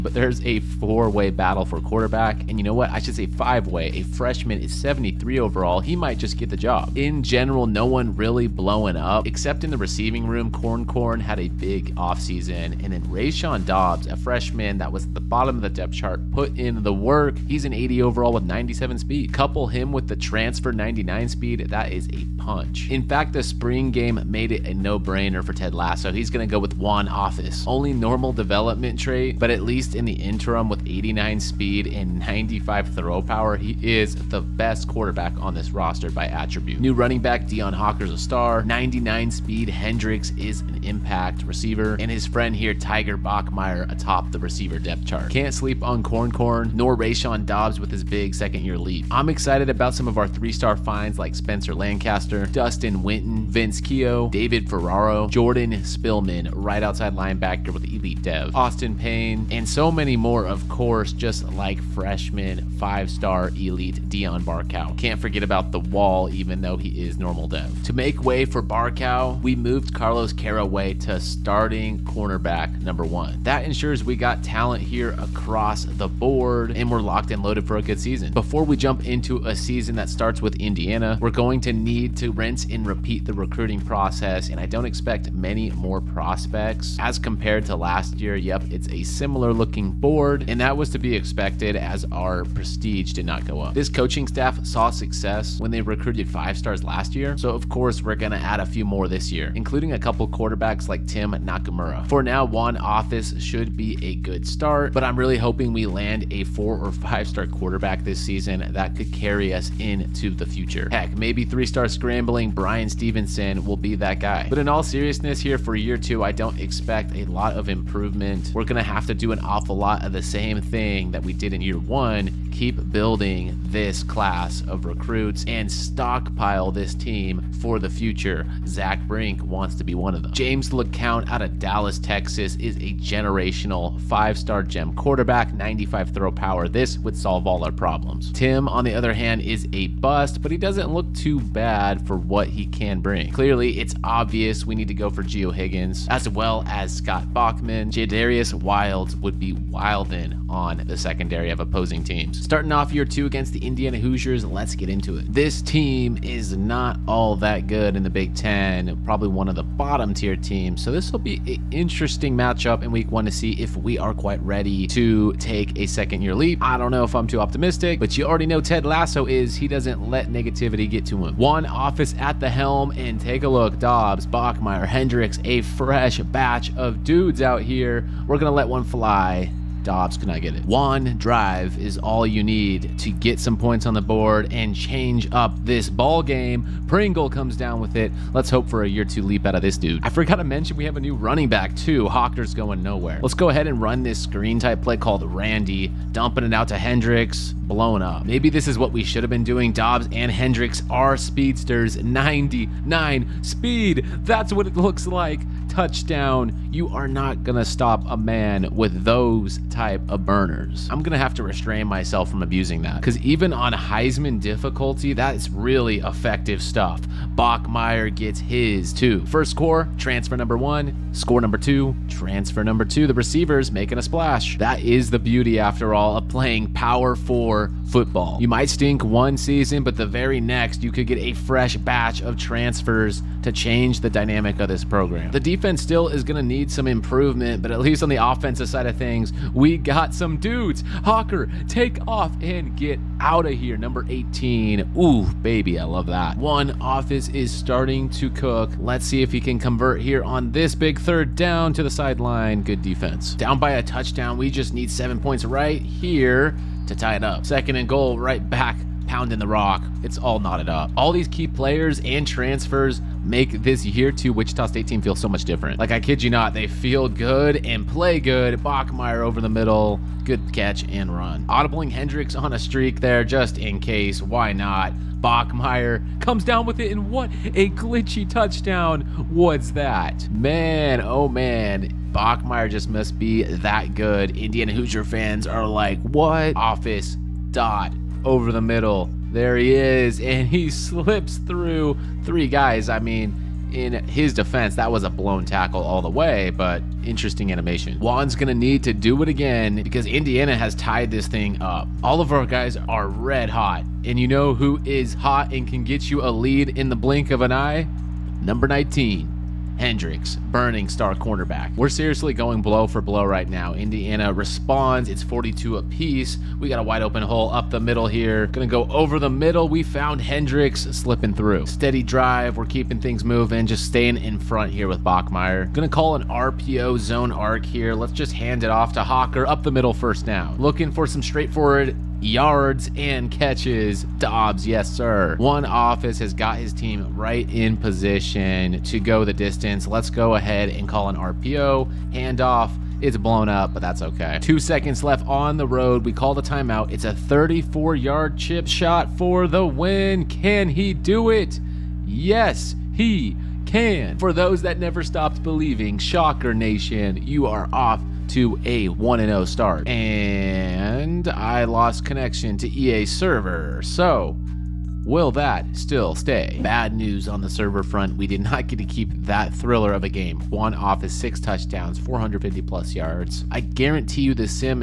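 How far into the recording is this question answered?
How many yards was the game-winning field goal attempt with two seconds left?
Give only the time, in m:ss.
5:47.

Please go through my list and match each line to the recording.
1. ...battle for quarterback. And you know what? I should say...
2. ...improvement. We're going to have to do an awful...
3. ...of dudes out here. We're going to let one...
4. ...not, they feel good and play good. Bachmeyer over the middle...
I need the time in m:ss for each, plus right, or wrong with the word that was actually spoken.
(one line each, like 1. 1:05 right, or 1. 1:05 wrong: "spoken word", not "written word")
1. 0:01 right
2. 1:57 right
3. 2:56 right
4. 4:26 right.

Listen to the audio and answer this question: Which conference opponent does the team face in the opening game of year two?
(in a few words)
Indiana Hoosiers.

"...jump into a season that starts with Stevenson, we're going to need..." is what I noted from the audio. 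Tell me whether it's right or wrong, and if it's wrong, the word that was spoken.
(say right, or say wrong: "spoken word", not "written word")
wrong: "Indiana", not "Stevenson".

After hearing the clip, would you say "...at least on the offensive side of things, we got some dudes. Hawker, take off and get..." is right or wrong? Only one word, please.
right.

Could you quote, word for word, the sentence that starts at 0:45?
Can't sleep on Corn Corn, nor or Rayshon Dobbs with his big second year leap.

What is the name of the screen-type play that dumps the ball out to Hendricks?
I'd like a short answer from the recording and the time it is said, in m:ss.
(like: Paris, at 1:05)
Randy, at 3:15.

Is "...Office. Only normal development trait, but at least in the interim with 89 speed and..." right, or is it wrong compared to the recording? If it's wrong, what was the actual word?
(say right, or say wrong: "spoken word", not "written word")
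right.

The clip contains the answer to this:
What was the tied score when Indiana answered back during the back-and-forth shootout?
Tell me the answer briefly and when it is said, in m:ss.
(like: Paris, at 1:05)
42, at 5:15.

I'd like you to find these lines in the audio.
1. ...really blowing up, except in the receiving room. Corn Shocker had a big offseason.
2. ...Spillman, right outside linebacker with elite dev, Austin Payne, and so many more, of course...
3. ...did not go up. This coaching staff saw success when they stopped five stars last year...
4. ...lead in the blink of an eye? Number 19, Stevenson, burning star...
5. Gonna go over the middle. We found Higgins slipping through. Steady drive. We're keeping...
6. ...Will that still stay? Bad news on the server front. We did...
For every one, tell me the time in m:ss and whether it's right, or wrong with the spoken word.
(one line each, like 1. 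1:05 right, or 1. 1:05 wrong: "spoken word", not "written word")
1. 0:08 wrong: "Corn", not "Shocker"
2. 0:55 right
3. 1:33 wrong: "recruited", not "stopped"
4. 5:06 wrong: "Hendricks", not "Stevenson"
5. 5:18 wrong: "Hendricks", not "Higgins"
6. 6:05 right.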